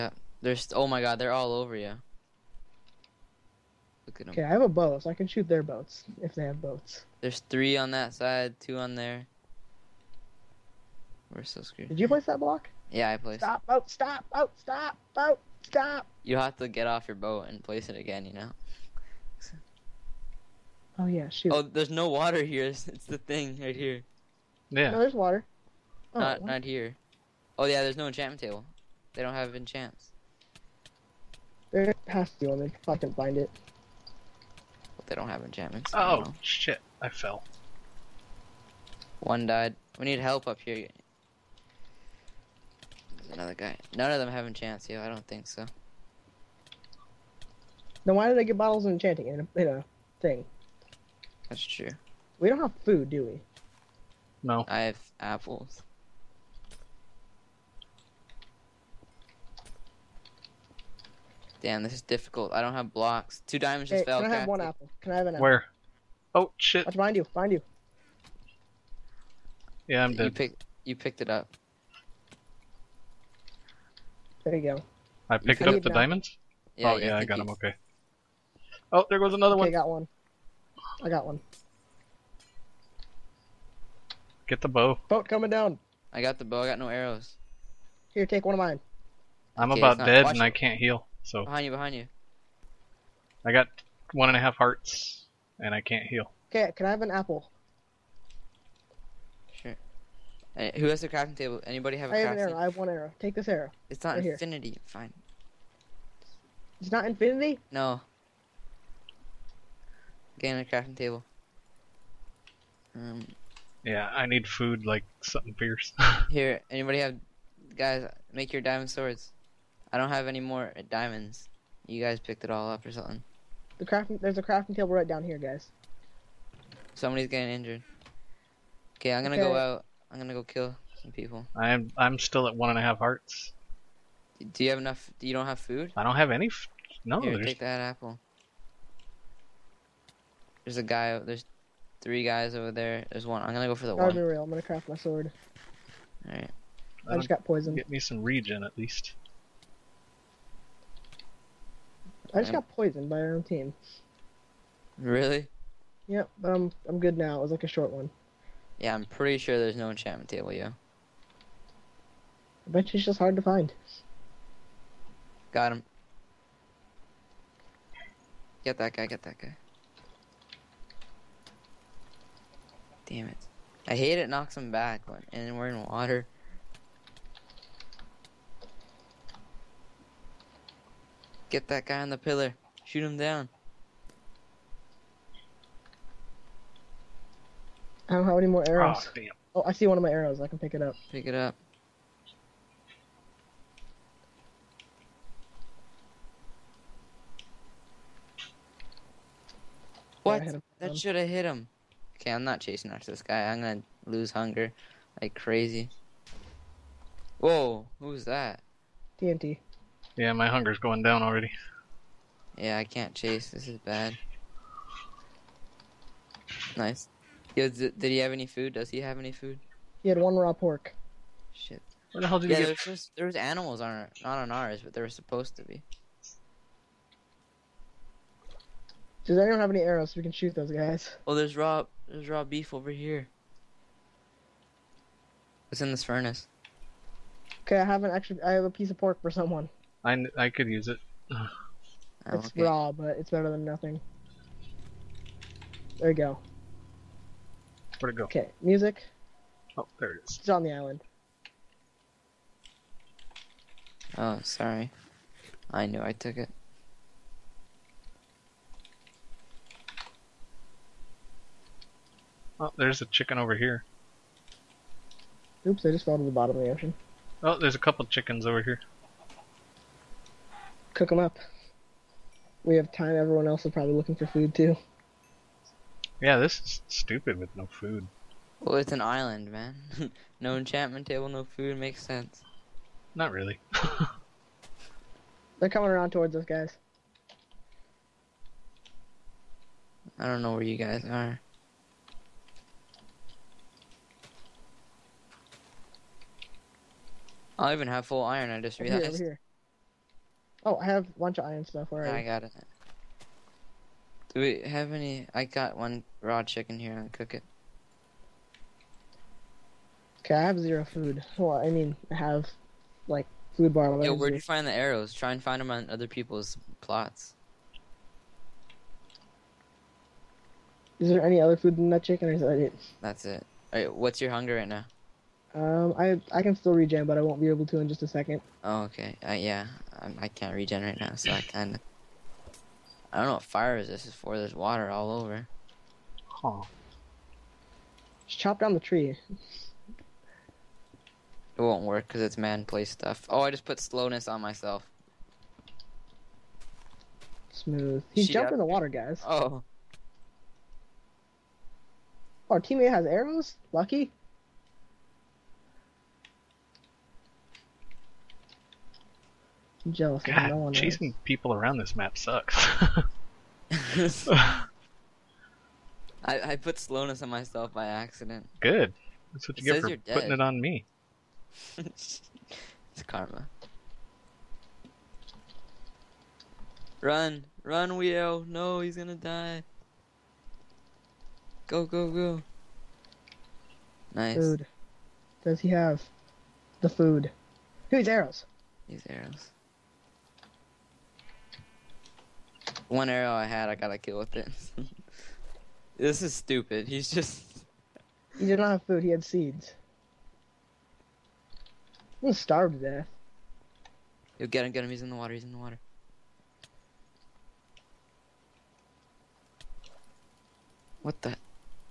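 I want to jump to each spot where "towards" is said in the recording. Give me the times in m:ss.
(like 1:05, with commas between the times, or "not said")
4:46.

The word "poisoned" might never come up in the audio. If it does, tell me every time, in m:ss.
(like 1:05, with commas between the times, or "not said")
2:27, 2:32.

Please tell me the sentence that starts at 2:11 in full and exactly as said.
I'm I'm still at one and a half hearts.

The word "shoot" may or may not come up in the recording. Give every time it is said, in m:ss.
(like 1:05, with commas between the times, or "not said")
0:05, 0:21, 3:02, 3:50.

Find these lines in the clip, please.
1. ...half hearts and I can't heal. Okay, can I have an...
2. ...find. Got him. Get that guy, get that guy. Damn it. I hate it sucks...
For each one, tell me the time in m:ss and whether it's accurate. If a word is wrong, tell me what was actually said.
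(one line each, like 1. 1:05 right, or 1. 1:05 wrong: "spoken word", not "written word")
1. 1:34 right
2. 2:43 wrong: "knocks", not "sucks".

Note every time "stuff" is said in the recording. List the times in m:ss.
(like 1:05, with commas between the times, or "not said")
5:01, 5:42.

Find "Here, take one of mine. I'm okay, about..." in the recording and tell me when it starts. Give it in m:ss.
1:28.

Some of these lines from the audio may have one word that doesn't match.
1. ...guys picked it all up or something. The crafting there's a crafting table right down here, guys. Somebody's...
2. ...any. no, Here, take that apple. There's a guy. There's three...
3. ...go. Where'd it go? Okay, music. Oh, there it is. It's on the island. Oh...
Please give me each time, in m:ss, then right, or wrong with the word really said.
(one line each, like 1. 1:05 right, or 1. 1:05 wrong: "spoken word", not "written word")
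1. 2:02 right
2. 2:16 right
3. 4:06 right.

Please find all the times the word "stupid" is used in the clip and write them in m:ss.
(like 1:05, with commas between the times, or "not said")
4:36, 6:36.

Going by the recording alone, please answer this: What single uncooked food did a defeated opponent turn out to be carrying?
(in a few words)
raw pork.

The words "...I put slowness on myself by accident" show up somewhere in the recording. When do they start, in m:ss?
6:06.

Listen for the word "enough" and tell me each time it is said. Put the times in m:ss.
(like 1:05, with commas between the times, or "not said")
2:14.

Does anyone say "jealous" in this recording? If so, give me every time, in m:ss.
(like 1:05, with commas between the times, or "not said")
5:59.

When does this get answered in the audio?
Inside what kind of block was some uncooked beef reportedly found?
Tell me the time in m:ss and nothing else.
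3:56.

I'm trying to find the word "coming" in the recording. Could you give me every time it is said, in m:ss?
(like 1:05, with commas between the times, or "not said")
1:25, 4:45.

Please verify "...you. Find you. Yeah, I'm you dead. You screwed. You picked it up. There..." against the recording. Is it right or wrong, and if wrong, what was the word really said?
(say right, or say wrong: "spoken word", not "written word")
wrong: "picked", not "screwed".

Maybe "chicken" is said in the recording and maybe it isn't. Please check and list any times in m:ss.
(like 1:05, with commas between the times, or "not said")
4:23, 4:28, 5:06, 5:22.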